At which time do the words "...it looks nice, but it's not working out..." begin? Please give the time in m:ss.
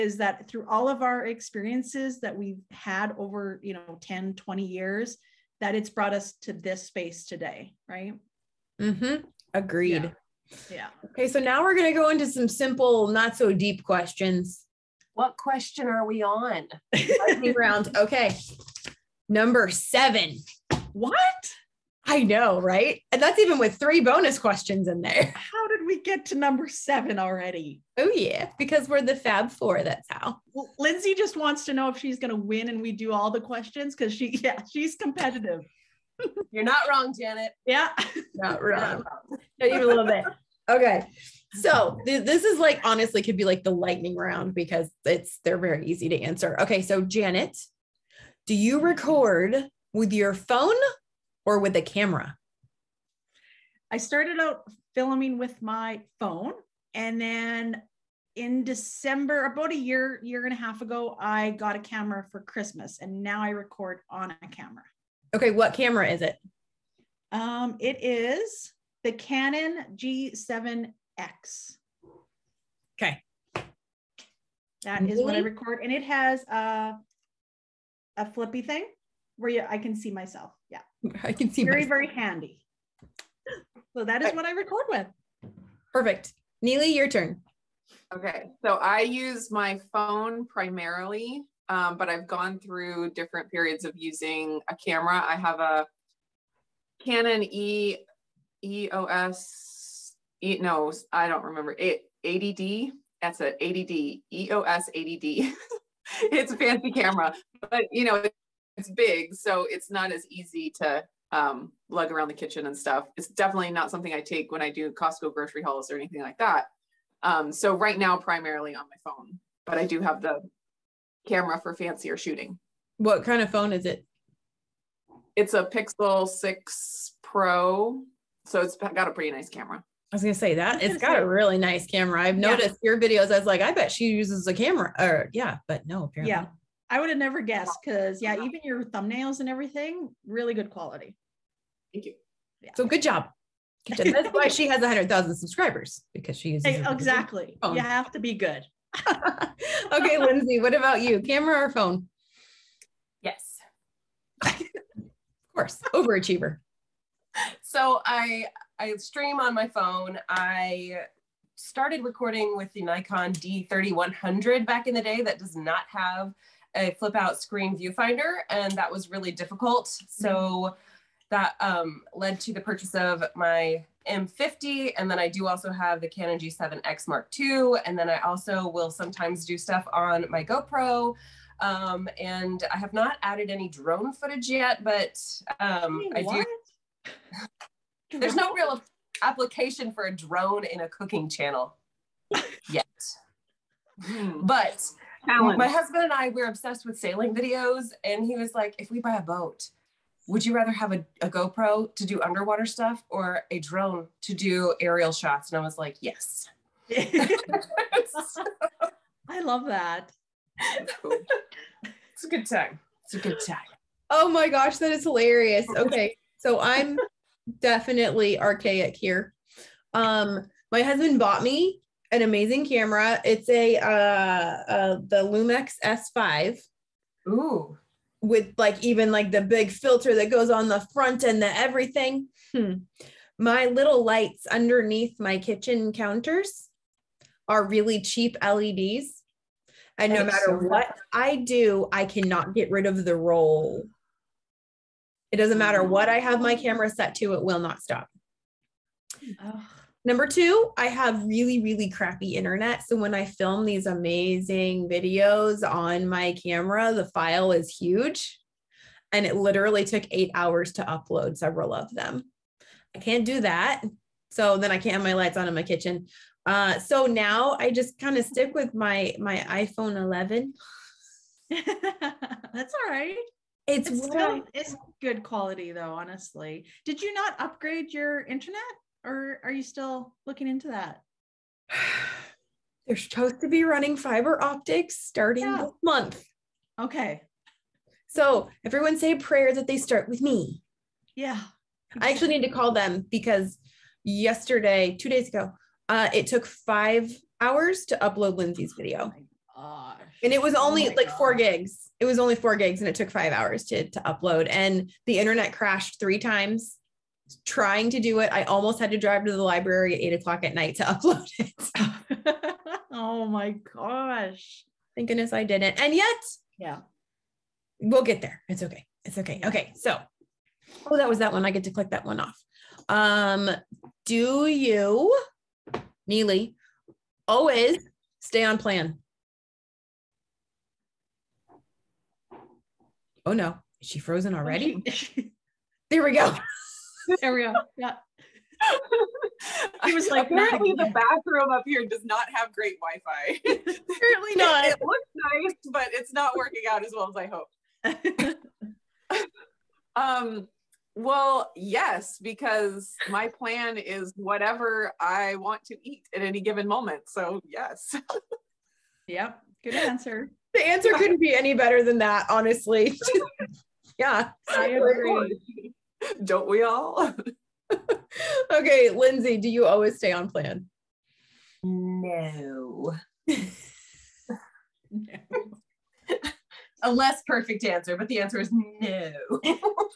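5:44.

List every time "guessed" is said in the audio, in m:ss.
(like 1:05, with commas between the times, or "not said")
2:17.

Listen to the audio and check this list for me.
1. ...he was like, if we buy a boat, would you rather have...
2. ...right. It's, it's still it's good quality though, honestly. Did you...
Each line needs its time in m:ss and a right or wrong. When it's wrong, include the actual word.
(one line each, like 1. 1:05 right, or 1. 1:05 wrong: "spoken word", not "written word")
1. 3:18 right
2. 4:32 right.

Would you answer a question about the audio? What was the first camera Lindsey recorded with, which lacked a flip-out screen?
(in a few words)
Nikon D3100.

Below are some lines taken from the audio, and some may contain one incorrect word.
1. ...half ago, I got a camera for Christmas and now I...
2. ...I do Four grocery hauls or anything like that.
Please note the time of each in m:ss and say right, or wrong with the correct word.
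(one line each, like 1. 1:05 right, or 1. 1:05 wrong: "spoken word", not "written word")
1. 1:00 right
2. 1:54 wrong: "Costco", not "Four".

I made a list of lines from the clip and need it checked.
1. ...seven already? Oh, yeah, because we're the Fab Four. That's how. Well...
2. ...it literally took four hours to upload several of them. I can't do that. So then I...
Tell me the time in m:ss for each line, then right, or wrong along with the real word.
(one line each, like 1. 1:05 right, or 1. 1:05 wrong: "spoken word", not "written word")
1. 0:26 right
2. 4:19 wrong: "eight", not "four".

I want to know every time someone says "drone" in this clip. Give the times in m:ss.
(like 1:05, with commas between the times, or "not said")
3:03, 3:10, 3:23.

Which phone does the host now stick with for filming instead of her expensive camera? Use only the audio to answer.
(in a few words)
iPhone 11.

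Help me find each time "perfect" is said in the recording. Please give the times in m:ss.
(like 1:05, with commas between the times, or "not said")
1:25, 6:17.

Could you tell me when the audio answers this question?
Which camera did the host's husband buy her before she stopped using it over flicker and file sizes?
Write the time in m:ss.
3:45.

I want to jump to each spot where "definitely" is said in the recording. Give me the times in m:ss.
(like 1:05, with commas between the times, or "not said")
1:53, 3:37.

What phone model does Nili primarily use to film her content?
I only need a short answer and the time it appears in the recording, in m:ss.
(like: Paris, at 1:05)
Pixel 6 Pro, at 2:05.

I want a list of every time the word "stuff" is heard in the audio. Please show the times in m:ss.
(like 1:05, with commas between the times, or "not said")
1:52, 2:59, 3:22.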